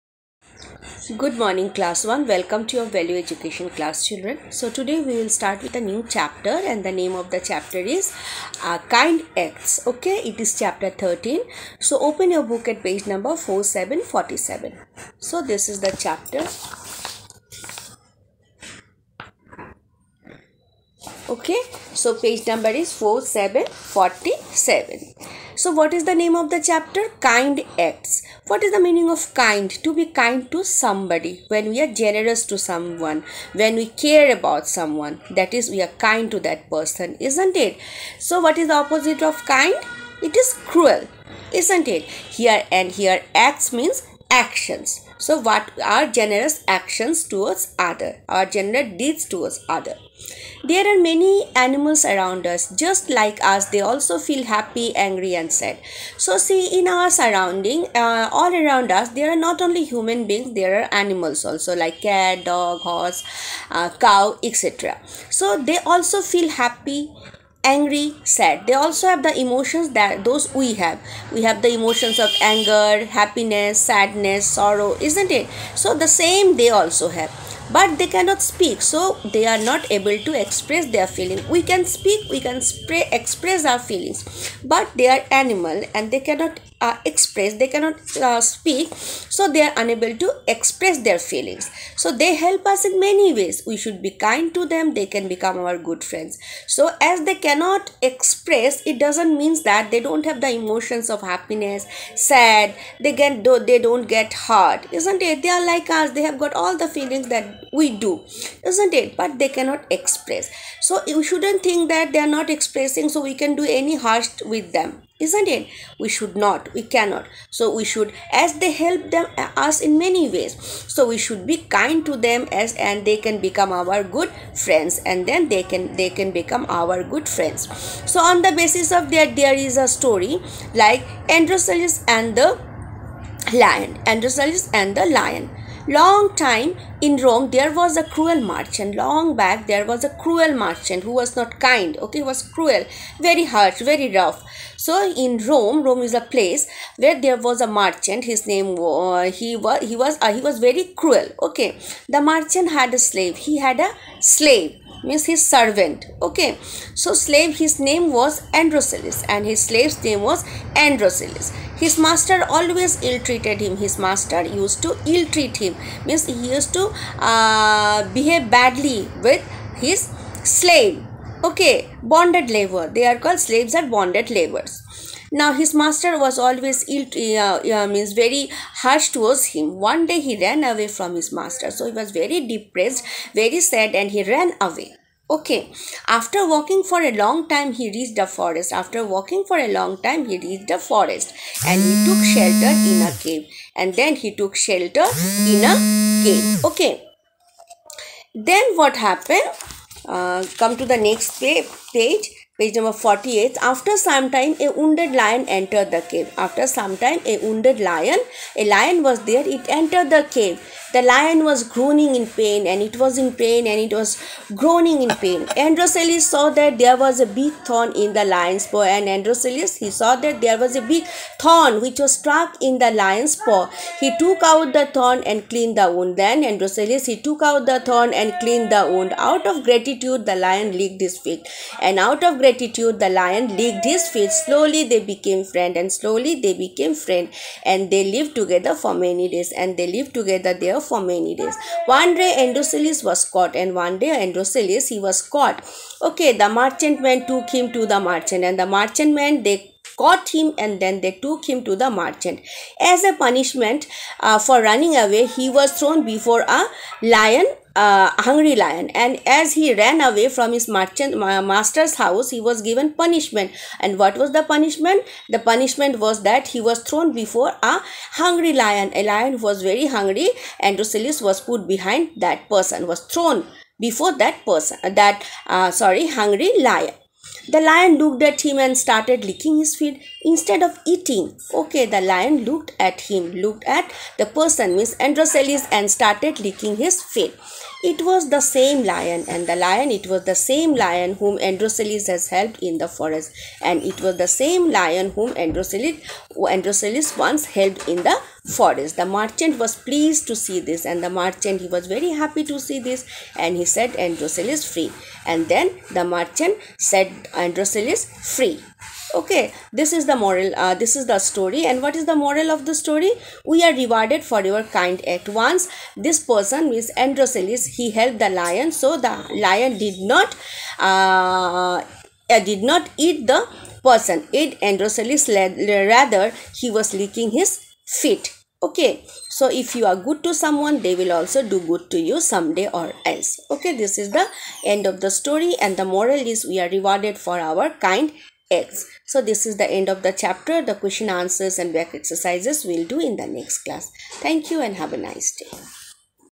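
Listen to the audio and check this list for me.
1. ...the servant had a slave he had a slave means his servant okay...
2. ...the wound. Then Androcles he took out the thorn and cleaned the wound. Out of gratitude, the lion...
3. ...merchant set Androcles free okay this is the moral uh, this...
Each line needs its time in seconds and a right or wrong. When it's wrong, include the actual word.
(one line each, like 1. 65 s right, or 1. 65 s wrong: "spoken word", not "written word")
1. 152 s wrong: "merchant", not "servant"
2. 225 s right
3. 306 s right.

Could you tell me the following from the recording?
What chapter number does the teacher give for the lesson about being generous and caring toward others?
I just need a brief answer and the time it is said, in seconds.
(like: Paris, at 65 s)
13, at 10 s.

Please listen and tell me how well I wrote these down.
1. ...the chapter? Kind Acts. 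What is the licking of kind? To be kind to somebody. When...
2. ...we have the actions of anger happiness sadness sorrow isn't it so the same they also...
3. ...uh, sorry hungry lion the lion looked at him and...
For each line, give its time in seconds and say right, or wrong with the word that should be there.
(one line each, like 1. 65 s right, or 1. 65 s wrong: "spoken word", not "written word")
1. 26 s wrong: "meaning", not "licking"
2. 71 s wrong: "emotions", not "actions"
3. 275 s right.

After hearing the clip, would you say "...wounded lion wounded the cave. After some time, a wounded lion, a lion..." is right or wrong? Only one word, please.
wrong.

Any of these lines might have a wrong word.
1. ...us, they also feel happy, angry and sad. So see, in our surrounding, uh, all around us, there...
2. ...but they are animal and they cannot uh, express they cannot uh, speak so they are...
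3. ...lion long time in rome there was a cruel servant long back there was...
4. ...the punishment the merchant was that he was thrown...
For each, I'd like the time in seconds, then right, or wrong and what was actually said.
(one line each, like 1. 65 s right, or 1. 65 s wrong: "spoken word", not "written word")
1. 53 s right
2. 84 s right
3. 135 s wrong: "merchant", not "servant"
4. 264 s wrong: "punishment", not "merchant".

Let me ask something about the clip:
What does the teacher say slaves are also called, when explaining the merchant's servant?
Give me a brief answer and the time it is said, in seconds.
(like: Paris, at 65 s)
Bonded laborers, at 173 s.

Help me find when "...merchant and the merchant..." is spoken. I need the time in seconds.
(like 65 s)
247 s.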